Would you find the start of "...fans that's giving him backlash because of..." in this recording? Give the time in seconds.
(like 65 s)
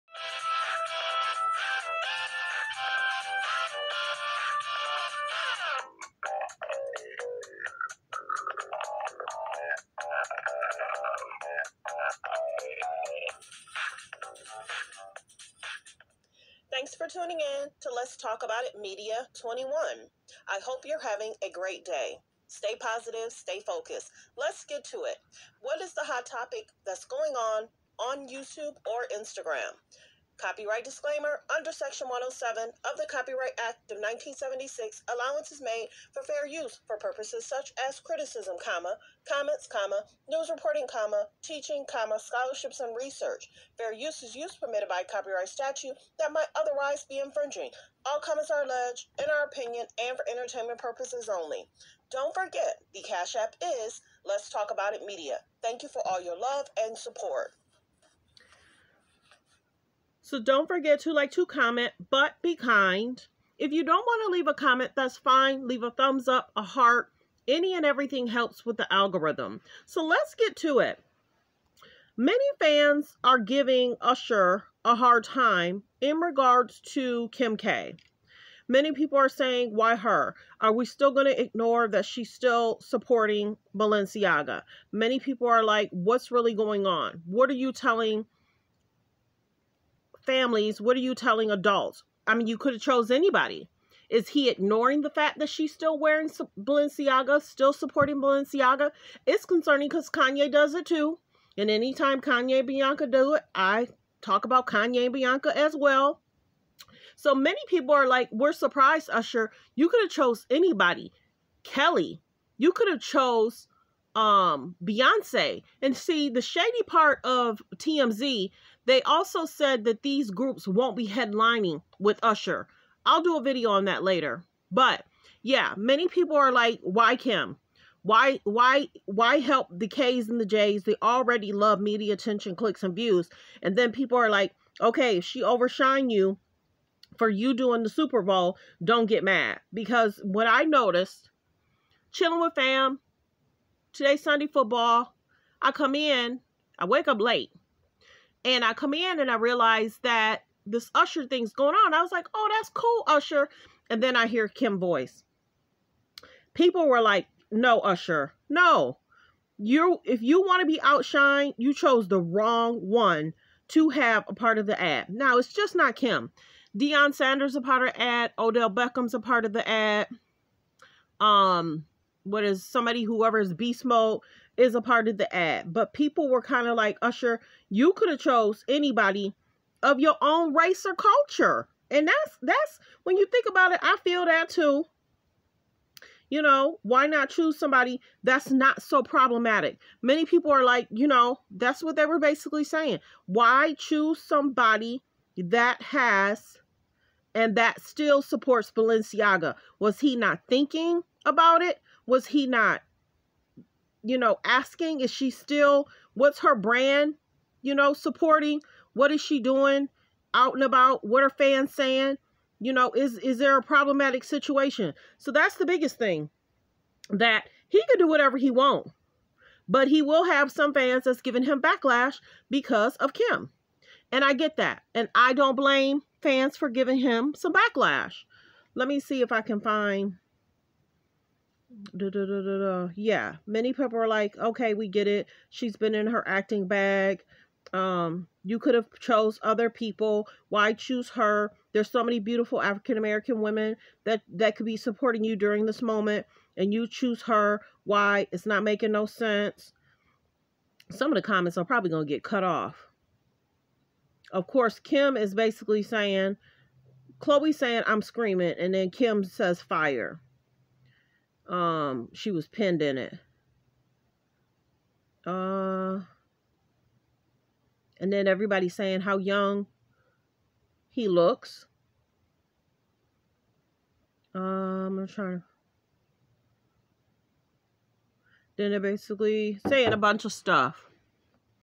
220 s.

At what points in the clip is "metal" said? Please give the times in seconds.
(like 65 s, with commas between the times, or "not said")
not said.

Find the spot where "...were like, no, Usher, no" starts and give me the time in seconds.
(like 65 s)
156 s.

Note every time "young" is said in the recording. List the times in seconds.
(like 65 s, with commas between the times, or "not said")
269 s.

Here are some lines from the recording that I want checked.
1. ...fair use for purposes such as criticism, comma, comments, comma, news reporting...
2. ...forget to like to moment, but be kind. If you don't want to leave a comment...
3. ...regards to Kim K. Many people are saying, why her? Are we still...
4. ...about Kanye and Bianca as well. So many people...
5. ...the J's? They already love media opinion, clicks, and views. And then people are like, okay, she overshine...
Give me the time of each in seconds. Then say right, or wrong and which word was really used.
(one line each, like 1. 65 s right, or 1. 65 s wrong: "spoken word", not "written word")
1. 36 s right
2. 60 s wrong: "comment", not "moment"
3. 76 s right
4. 104 s right
5. 130 s wrong: "attention", not "opinion".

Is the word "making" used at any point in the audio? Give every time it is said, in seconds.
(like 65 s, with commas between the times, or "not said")
248 s.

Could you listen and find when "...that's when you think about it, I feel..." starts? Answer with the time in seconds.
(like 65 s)
182 s.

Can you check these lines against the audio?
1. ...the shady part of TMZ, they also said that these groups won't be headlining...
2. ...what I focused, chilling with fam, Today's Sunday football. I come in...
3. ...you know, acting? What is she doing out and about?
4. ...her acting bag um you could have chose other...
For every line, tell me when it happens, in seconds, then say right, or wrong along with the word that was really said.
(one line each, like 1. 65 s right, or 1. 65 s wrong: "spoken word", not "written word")
1. 116 s right
2. 140 s wrong: "noticed", not "focused"
3. 207 s wrong: "supporting", not "acting"
4. 236 s right.